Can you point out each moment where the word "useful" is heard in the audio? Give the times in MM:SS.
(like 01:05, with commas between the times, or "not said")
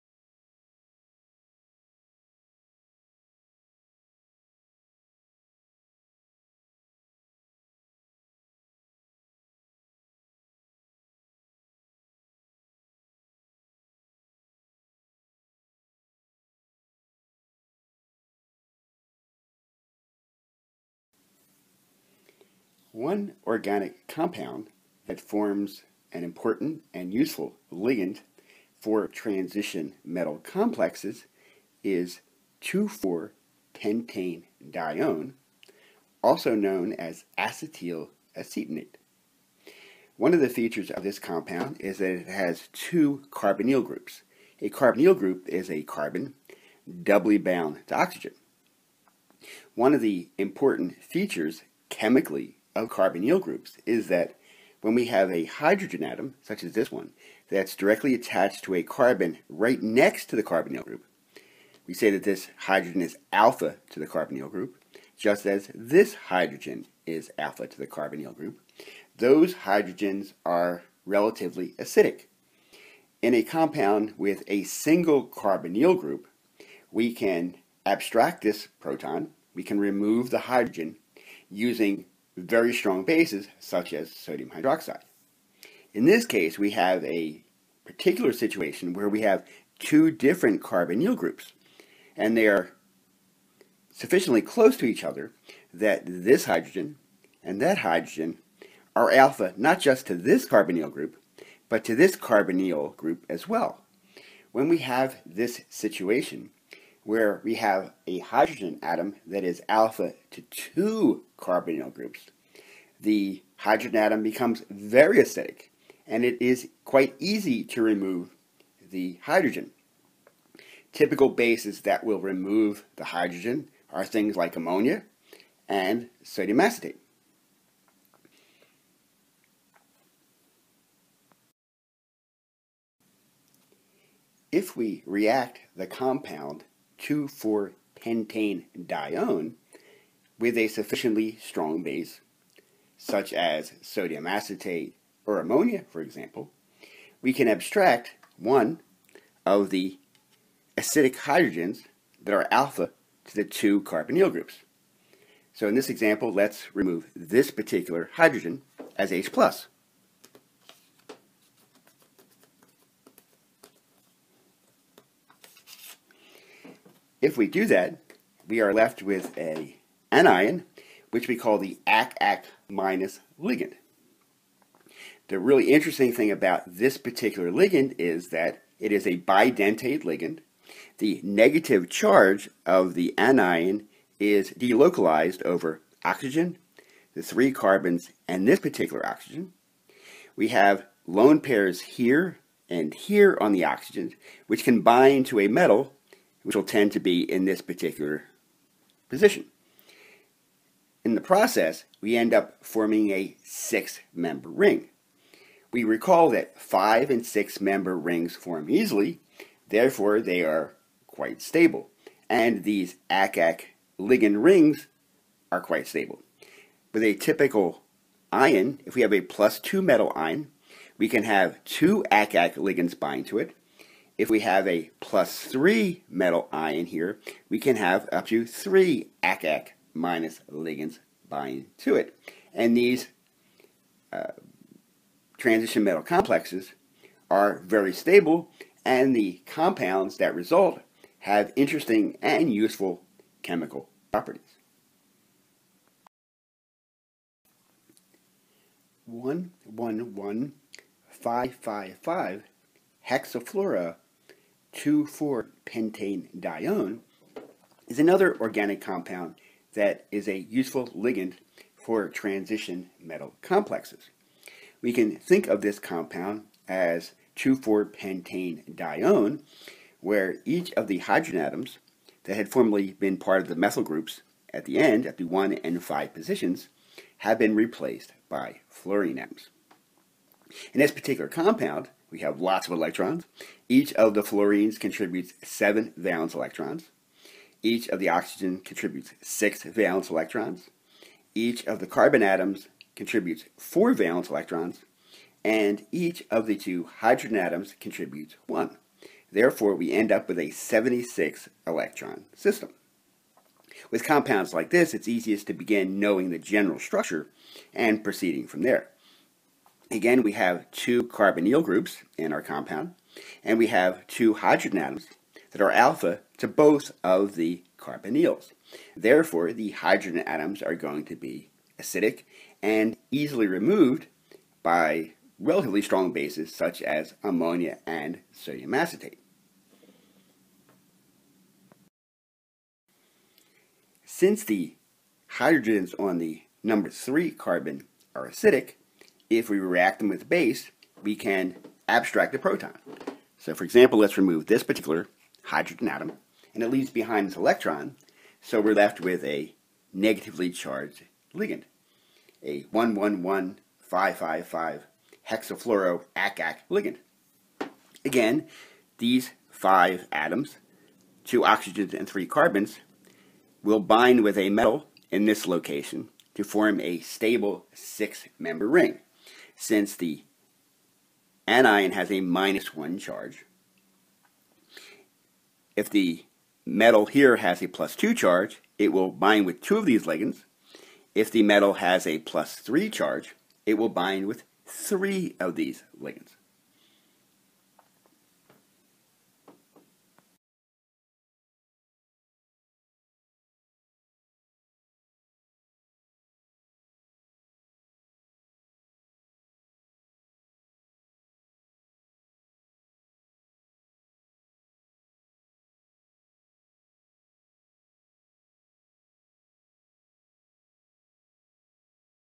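00:27, 04:02, 04:20.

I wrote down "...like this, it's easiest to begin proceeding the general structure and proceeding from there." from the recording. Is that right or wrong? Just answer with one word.
wrong.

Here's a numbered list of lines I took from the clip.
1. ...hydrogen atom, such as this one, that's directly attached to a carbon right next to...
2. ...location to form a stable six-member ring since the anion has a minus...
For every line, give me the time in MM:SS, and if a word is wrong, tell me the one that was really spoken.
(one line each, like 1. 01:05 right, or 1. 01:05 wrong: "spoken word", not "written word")
1. 00:55 right
2. 06:05 right.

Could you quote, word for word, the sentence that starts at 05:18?
Therefore, the hydrogen atoms are going to be acidic and easily removed by relatively strong bases such as ammonia and sodium acetate.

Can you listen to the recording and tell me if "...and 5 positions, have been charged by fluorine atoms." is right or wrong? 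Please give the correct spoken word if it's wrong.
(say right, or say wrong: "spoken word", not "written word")
wrong: "replaced", not "charged".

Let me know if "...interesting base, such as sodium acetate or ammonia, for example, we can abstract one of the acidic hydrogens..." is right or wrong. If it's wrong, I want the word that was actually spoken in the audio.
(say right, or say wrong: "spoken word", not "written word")
wrong: "strong", not "interesting".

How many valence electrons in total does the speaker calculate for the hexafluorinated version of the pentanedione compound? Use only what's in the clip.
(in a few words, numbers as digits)
76.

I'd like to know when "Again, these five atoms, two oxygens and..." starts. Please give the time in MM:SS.
05:58.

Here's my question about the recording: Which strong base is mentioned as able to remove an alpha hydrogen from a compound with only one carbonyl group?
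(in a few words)
sodium hydroxide.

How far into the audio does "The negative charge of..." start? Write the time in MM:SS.
03:00.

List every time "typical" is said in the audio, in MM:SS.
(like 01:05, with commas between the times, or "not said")
02:00, 03:37.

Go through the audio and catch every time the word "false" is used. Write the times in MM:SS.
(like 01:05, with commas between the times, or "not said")
not said.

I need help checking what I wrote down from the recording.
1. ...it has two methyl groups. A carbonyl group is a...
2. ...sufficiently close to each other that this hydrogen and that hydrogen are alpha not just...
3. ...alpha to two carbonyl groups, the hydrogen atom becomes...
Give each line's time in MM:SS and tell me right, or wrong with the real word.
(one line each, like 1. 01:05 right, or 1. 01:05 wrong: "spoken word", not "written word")
1. 00:42 wrong: "carbonyl", not "methyl"
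2. 01:33 right
3. 01:49 right.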